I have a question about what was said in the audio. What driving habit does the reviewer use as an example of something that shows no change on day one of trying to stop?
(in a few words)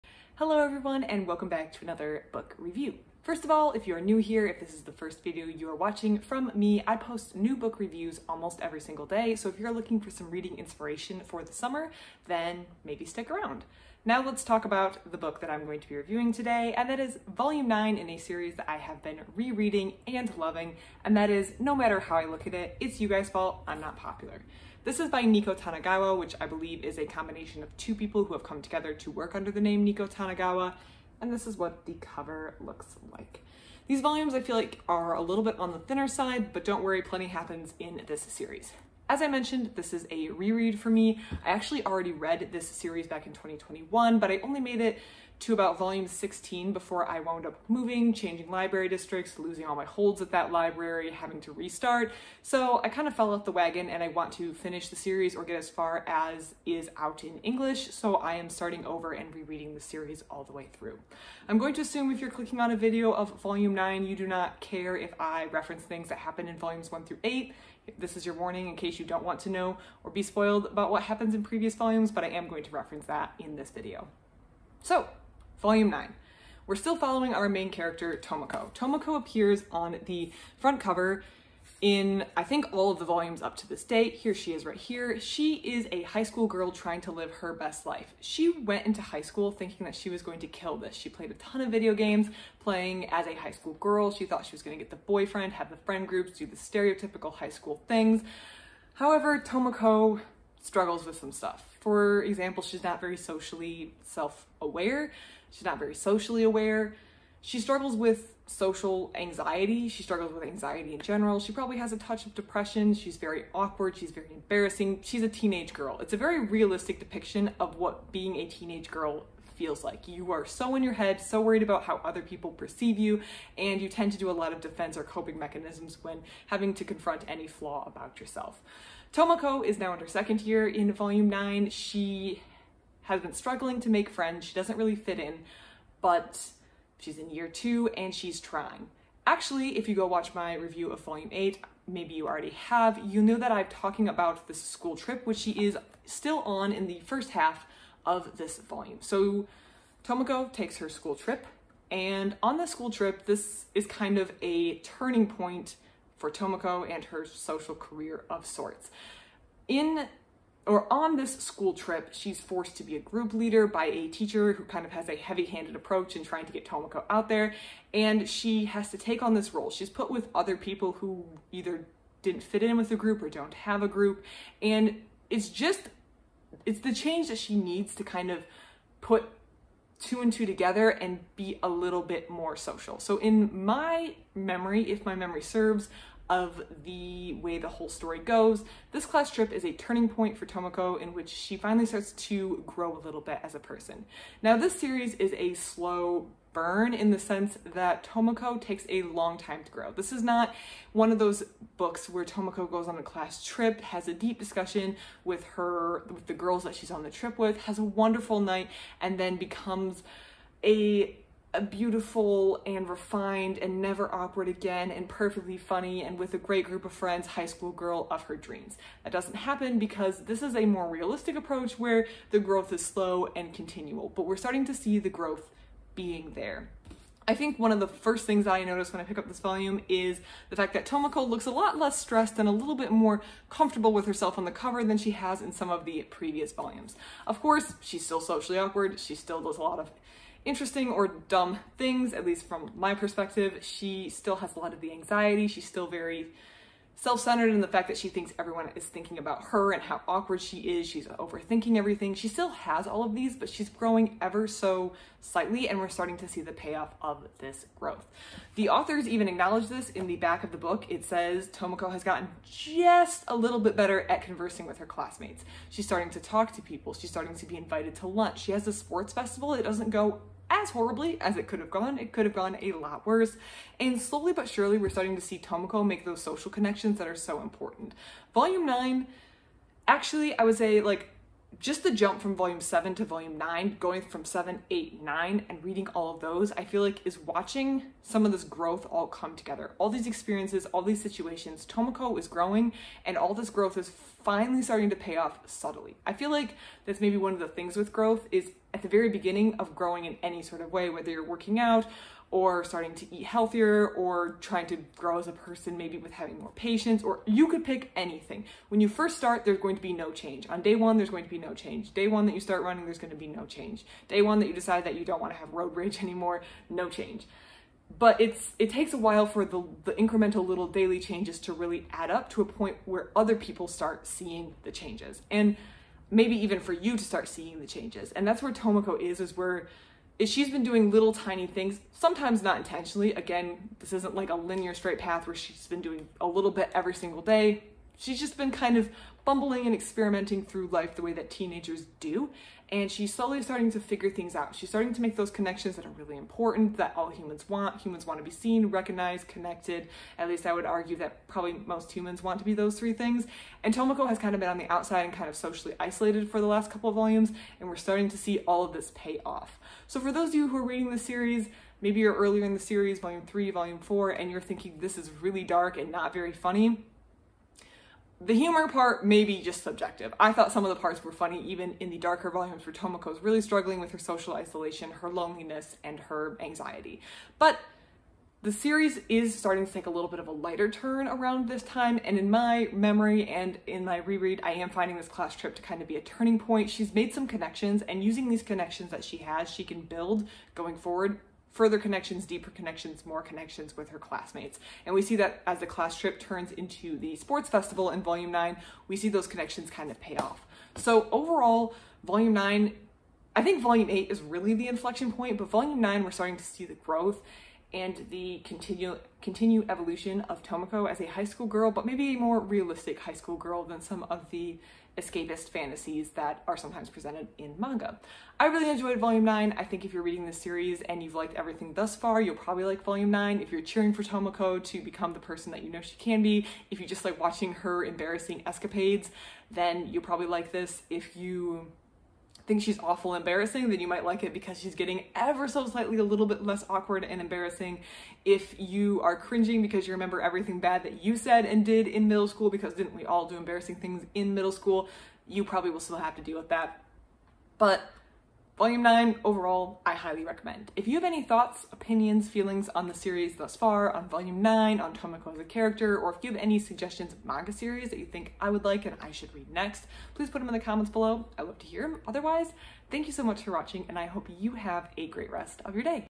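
Road rage.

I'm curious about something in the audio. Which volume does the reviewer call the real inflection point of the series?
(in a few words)
8.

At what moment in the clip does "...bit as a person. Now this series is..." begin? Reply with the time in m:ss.
3:13.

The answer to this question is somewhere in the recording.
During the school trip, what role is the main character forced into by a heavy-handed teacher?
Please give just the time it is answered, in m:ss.
2:42.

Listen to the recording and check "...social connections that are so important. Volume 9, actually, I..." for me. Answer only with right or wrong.
right.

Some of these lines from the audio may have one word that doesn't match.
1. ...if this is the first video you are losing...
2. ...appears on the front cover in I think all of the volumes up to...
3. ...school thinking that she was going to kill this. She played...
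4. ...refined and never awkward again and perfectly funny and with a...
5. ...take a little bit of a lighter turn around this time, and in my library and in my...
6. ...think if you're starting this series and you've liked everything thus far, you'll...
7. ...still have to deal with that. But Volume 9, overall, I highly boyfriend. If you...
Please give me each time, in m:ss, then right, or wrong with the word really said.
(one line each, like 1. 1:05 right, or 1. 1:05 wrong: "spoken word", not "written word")
1. 0:04 wrong: "watching", not "losing"
2. 1:19 right
3. 1:29 right
4. 3:32 right
5. 6:19 wrong: "memory", not "library"
6. 6:59 wrong: "reading", not "starting"
7. 7:25 wrong: "recommend", not "boyfriend".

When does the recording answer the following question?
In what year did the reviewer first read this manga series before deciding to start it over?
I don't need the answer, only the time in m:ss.
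0:43.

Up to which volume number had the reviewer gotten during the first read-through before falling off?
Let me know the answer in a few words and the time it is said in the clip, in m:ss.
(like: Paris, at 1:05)
16, at 0:45.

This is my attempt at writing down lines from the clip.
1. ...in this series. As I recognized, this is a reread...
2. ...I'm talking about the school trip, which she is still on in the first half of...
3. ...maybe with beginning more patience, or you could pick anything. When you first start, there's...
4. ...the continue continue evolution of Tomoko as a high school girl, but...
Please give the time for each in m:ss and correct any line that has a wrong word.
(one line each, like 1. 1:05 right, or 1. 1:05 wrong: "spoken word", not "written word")
1. 0:37 wrong: "mentioned", not "recognized"
2. 2:23 right
3. 5:05 wrong: "having", not "beginning"
4. 6:48 right.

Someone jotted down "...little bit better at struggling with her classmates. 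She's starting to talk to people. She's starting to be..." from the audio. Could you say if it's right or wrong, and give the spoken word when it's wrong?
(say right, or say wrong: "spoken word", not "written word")
wrong: "conversing", not "struggling".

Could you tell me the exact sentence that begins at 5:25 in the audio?
And maybe even for you to start seeing the changes.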